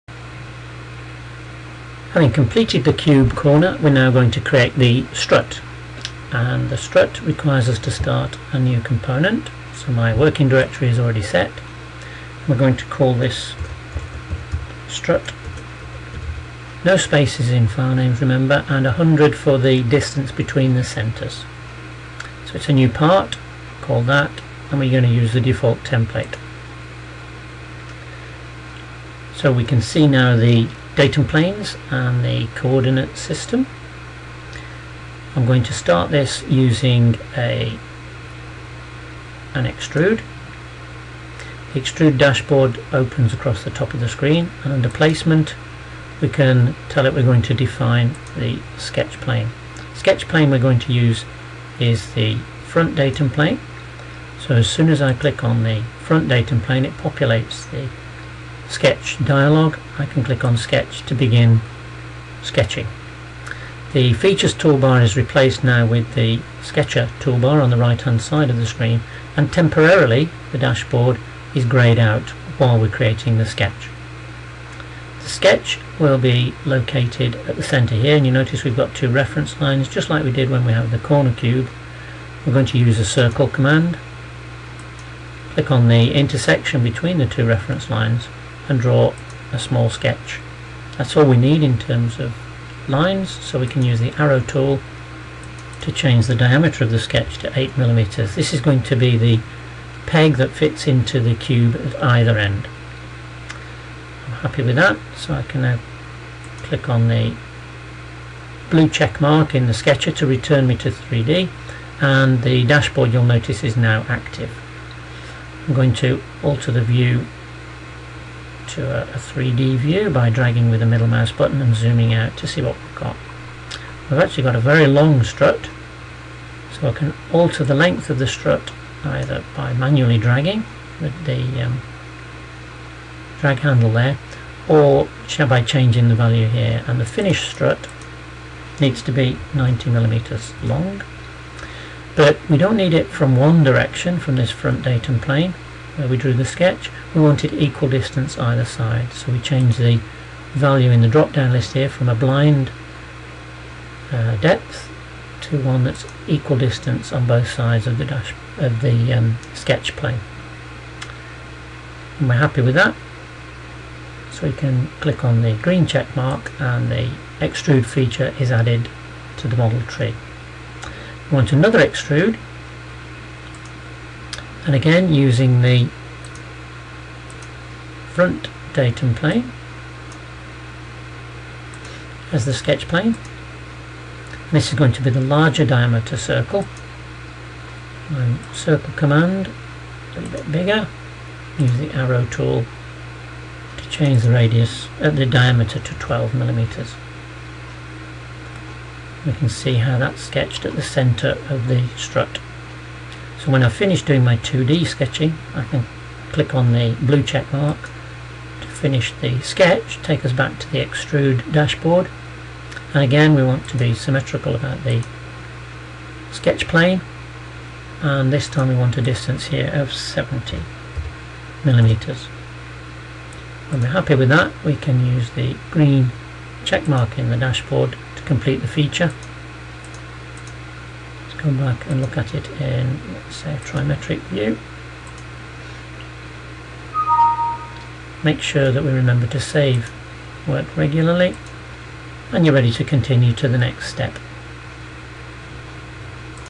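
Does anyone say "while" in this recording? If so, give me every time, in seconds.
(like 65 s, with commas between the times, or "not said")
72 s.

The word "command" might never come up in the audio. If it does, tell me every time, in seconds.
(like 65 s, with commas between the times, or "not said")
83 s, 188 s.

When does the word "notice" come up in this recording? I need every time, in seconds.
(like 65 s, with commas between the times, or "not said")
78 s, 113 s.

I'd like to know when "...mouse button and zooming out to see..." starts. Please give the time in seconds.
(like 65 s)
121 s.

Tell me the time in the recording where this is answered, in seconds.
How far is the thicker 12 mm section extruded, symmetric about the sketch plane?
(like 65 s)
219 s.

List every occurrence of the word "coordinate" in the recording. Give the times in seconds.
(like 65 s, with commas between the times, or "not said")
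32 s.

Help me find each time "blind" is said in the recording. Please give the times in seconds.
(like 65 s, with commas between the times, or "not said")
152 s.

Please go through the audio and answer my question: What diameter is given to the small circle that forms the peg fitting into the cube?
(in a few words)
8 millimeters.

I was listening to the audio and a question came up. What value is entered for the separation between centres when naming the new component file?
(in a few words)
100.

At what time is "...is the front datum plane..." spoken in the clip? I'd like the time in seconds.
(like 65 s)
51 s.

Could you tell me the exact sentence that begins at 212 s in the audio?
And again, we want to be symmetrical about the sketch plane.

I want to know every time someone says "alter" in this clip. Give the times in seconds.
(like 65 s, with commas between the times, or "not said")
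116 s, 127 s.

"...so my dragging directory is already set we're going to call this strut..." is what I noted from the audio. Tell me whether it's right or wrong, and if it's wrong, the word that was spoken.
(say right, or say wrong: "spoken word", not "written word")
wrong: "working", not "dragging".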